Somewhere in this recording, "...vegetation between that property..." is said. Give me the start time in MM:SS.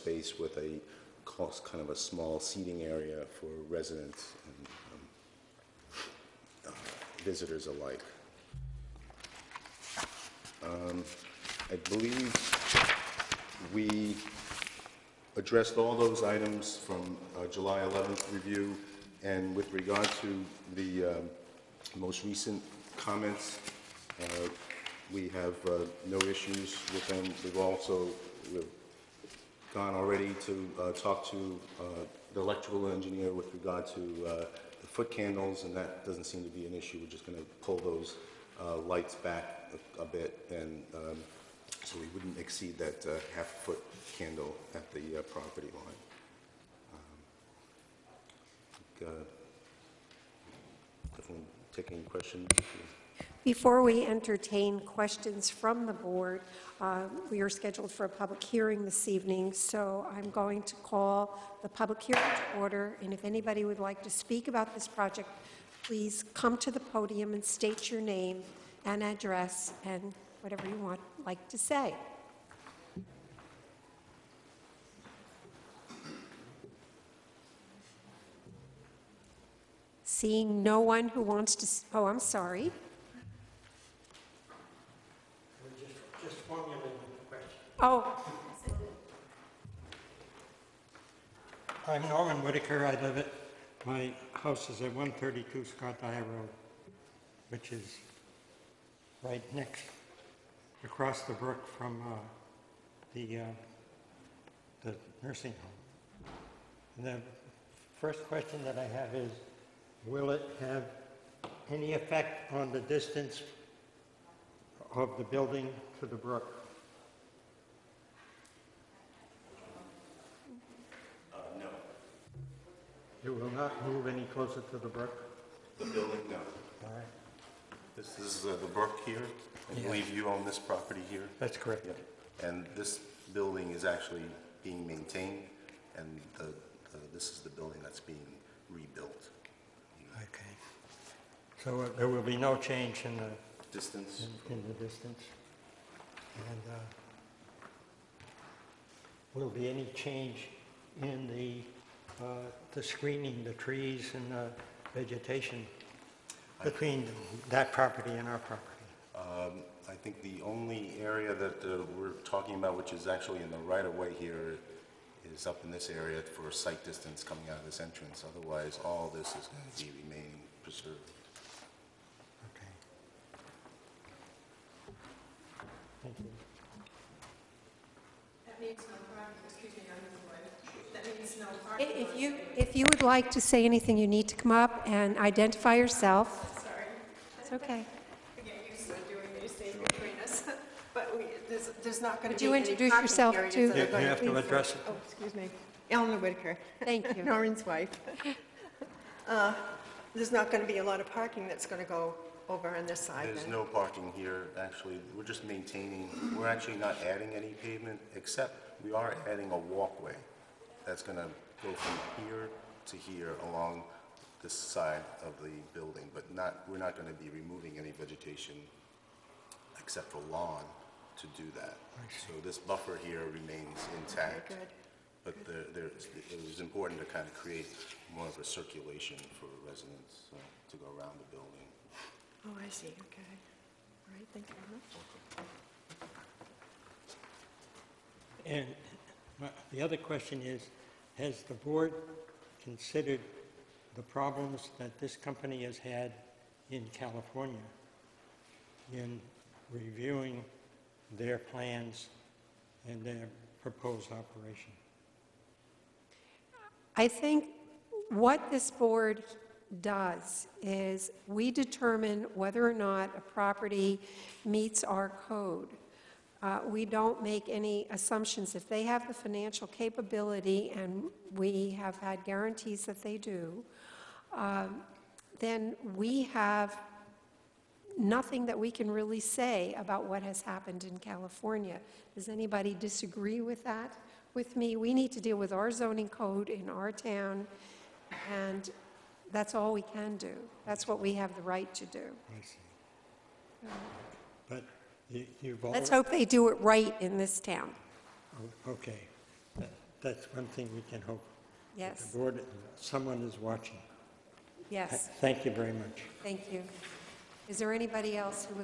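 02:34.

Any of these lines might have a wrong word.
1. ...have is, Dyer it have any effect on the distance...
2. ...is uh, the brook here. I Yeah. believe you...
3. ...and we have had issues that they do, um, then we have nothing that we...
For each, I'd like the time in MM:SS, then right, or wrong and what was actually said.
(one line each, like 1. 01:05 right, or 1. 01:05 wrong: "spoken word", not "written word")
1. 01:48 wrong: "Will", not "Dyer"
2. 02:08 right
3. 04:30 wrong: "guarantees", not "issues".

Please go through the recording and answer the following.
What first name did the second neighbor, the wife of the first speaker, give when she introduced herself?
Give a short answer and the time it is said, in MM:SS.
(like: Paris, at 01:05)
Eleanor, at 03:15.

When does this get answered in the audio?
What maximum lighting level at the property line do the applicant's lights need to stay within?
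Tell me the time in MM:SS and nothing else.
00:43.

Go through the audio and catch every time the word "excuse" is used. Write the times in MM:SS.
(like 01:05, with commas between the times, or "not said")
03:15.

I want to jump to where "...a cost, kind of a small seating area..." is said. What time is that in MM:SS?
00:00.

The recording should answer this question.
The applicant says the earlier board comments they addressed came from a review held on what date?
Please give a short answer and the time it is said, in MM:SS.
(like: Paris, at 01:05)
July 11th, at 00:17.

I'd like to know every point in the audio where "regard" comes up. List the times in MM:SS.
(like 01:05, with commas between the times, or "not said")
00:19, 00:33.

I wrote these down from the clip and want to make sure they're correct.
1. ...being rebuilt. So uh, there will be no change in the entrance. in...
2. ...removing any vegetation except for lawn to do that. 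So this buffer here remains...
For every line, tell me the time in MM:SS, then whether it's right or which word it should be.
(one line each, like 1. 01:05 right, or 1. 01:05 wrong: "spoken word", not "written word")
1. 02:17 wrong: "distance", not "entrance"
2. 03:37 right.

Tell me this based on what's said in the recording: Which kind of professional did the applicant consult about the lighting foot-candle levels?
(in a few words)
Electrical engineer.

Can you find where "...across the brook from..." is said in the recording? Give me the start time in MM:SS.
01:40.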